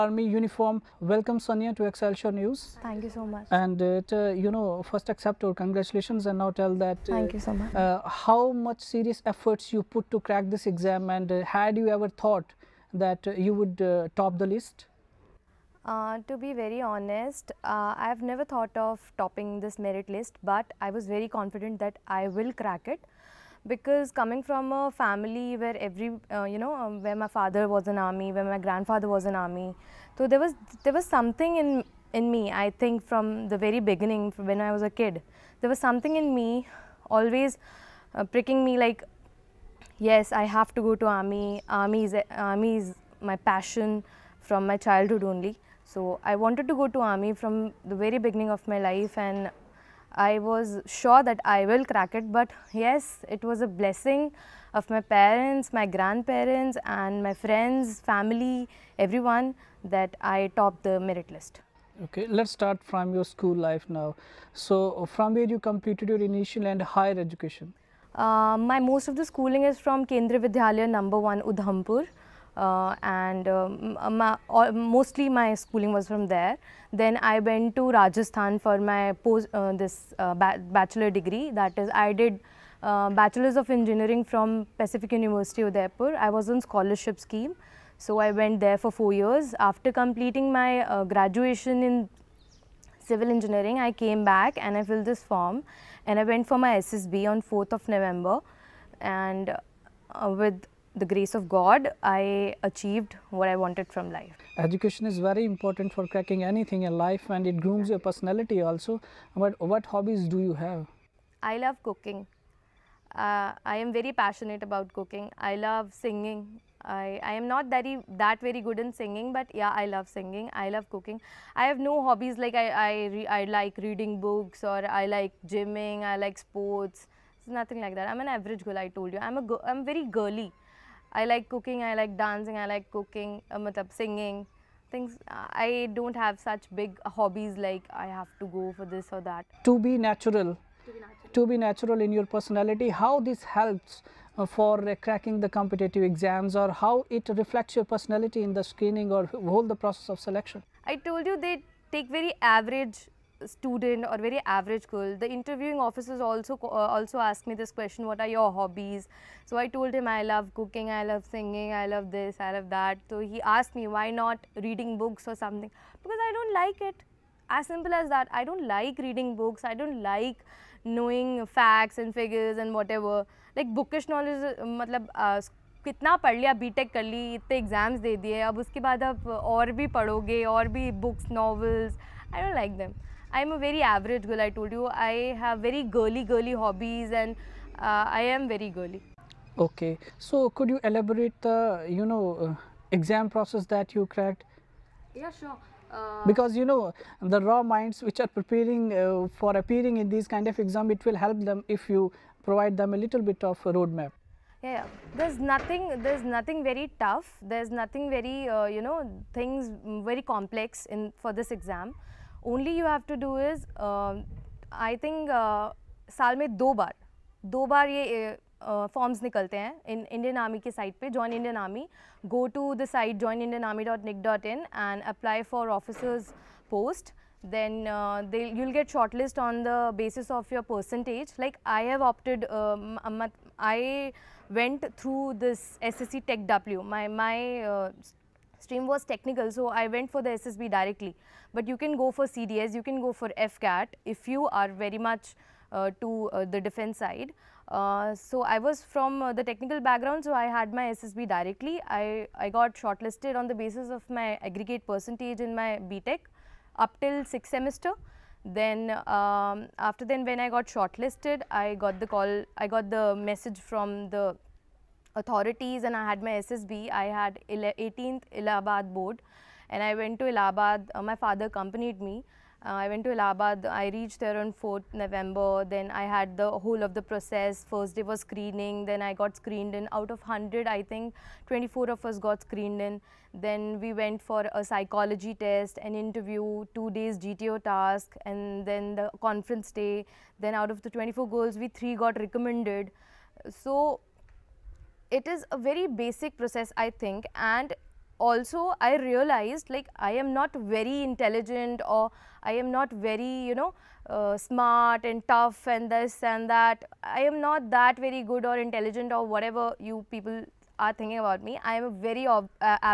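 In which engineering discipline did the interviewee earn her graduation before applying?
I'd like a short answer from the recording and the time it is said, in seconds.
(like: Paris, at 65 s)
Civil engineering, at 93 s.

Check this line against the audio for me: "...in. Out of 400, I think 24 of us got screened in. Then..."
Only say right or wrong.
wrong.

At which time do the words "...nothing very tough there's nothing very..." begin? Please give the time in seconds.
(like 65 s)
206 s.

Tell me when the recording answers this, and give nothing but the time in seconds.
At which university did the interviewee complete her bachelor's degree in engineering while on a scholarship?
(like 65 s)
84 s.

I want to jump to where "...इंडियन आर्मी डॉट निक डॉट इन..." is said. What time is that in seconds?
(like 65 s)
223 s.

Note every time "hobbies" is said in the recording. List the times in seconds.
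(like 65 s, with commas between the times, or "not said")
109 s, 122 s, 137 s, 158 s, 186 s.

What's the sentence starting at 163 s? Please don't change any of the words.
So he asked me why not reading books or something because I don't like it.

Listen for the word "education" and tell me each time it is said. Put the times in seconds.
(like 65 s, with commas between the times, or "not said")
67 s, 104 s.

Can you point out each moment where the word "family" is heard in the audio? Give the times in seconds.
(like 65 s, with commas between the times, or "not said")
24 s, 58 s.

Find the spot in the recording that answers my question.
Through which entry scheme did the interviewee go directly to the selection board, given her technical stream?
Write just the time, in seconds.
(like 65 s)
235 s.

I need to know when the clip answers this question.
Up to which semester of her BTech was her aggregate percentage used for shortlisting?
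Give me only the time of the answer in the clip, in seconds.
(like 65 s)
257 s.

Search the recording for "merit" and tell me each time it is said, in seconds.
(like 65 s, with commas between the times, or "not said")
19 s, 60 s.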